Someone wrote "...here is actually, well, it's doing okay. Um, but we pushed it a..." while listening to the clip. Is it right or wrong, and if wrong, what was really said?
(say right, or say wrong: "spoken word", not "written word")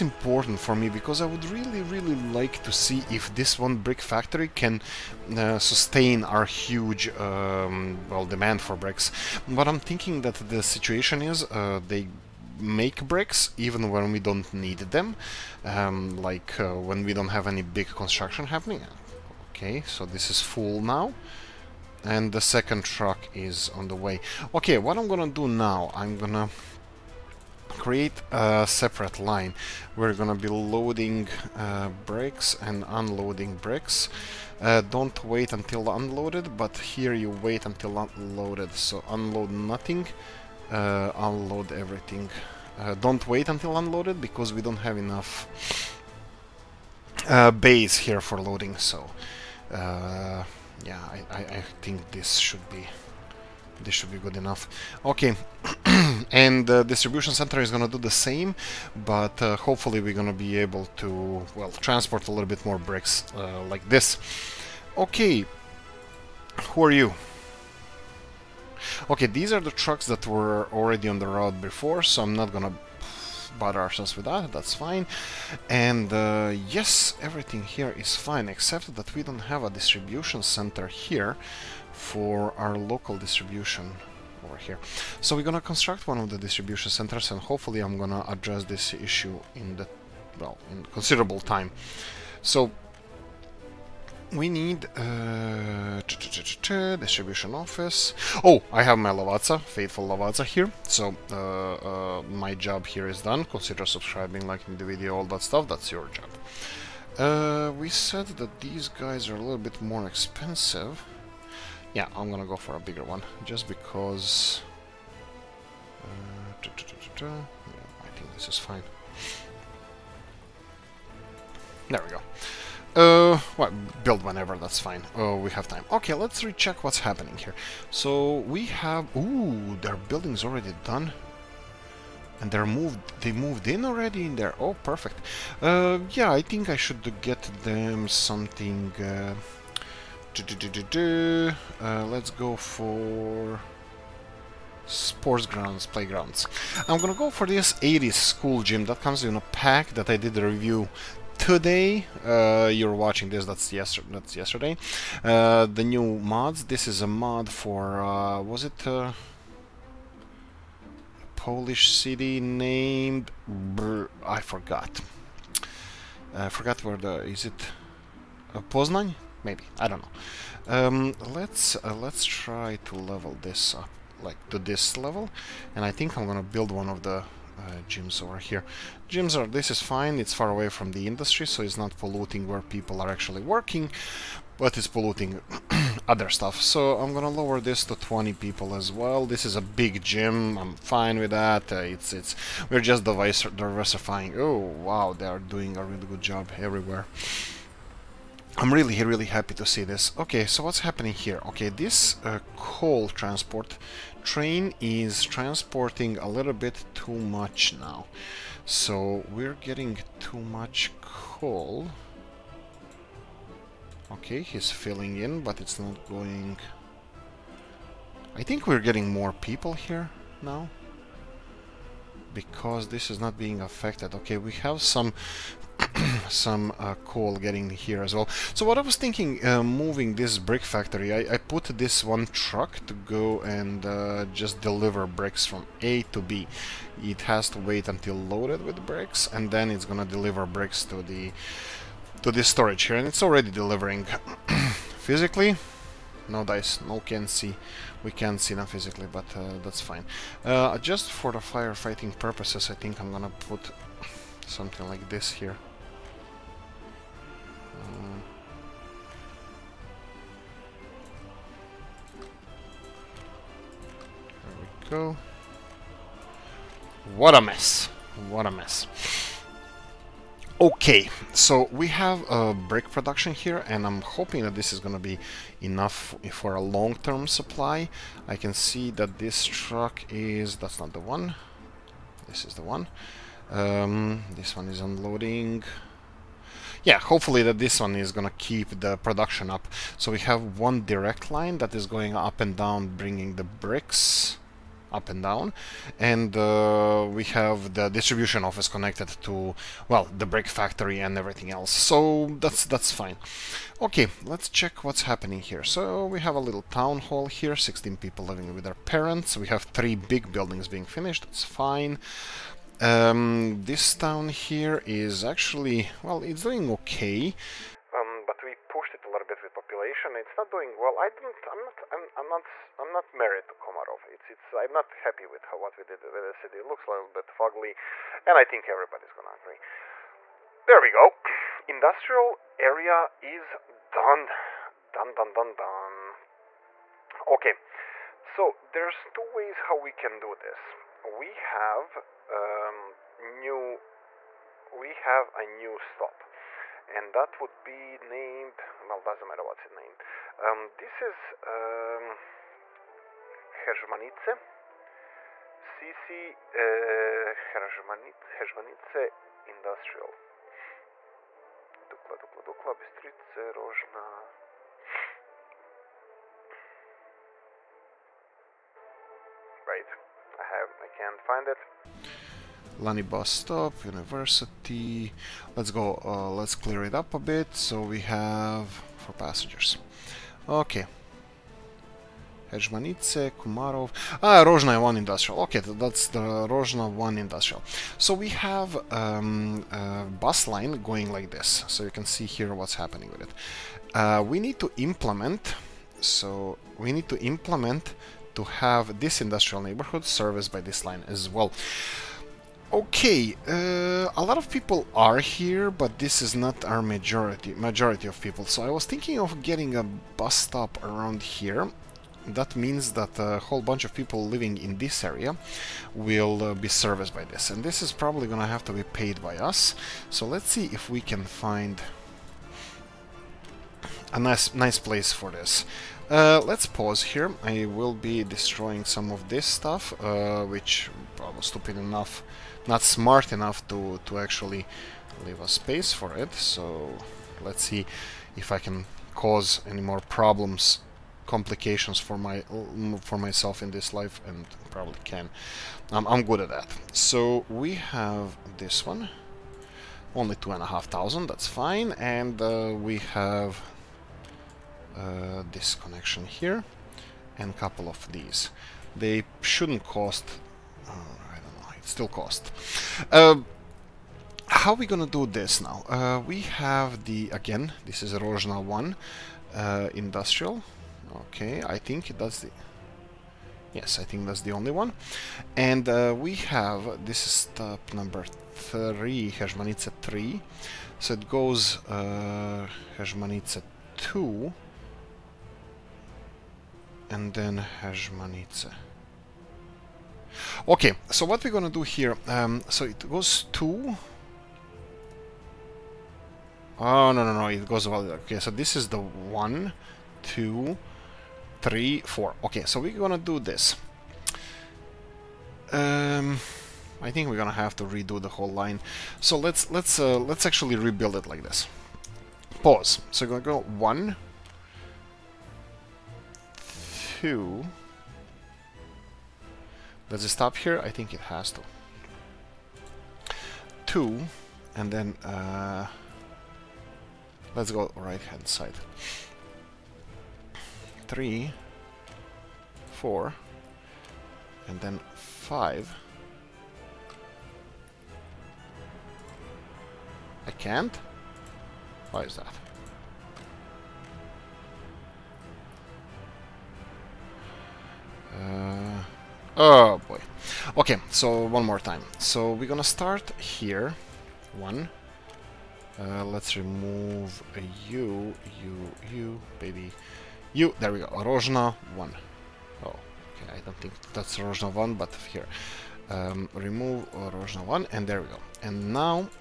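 right.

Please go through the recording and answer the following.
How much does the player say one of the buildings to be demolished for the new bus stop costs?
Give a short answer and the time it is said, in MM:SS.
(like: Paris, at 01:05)
2,500, at 07:30.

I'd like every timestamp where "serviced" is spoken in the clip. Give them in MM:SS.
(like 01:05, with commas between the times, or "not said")
06:40, 06:56.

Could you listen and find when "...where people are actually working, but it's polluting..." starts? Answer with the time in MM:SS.
03:02.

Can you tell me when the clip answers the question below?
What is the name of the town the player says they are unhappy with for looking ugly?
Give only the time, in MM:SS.
05:23.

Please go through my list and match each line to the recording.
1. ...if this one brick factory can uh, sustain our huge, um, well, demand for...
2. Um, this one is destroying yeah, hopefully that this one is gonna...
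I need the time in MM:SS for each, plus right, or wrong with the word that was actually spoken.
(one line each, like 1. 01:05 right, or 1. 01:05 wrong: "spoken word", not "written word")
1. 00:03 right
2. 04:43 wrong: "unloading", not "destroying".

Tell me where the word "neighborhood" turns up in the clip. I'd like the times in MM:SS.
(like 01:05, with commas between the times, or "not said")
06:39.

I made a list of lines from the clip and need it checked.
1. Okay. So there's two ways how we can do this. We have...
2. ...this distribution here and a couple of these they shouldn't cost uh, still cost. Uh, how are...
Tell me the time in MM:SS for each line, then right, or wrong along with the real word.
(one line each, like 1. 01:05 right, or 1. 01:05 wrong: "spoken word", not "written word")
1. 05:37 right
2. 07:35 wrong: "connection", not "distribution".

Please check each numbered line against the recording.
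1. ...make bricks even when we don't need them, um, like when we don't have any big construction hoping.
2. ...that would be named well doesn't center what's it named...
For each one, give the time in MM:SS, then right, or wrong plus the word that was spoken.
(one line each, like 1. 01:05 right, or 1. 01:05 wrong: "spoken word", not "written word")
1. 00:12 wrong: "happening", not "hoping"
2. 05:47 wrong: "matter", not "center".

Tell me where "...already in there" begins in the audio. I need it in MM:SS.
02:13.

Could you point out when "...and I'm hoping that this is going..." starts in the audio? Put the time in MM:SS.
04:33.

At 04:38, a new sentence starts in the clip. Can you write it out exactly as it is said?
I can see that this truck is...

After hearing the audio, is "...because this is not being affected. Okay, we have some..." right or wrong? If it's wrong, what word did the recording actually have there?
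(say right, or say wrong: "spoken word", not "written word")
right.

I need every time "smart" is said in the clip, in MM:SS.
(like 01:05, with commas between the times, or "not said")
07:12.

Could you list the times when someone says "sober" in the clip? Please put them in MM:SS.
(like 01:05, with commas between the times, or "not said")
not said.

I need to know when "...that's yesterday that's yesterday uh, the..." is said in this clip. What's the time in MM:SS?
02:33.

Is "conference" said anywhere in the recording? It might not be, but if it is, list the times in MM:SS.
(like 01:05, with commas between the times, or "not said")
not said.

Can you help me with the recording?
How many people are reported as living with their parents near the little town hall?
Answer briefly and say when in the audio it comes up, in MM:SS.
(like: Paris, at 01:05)
16, at 05:07.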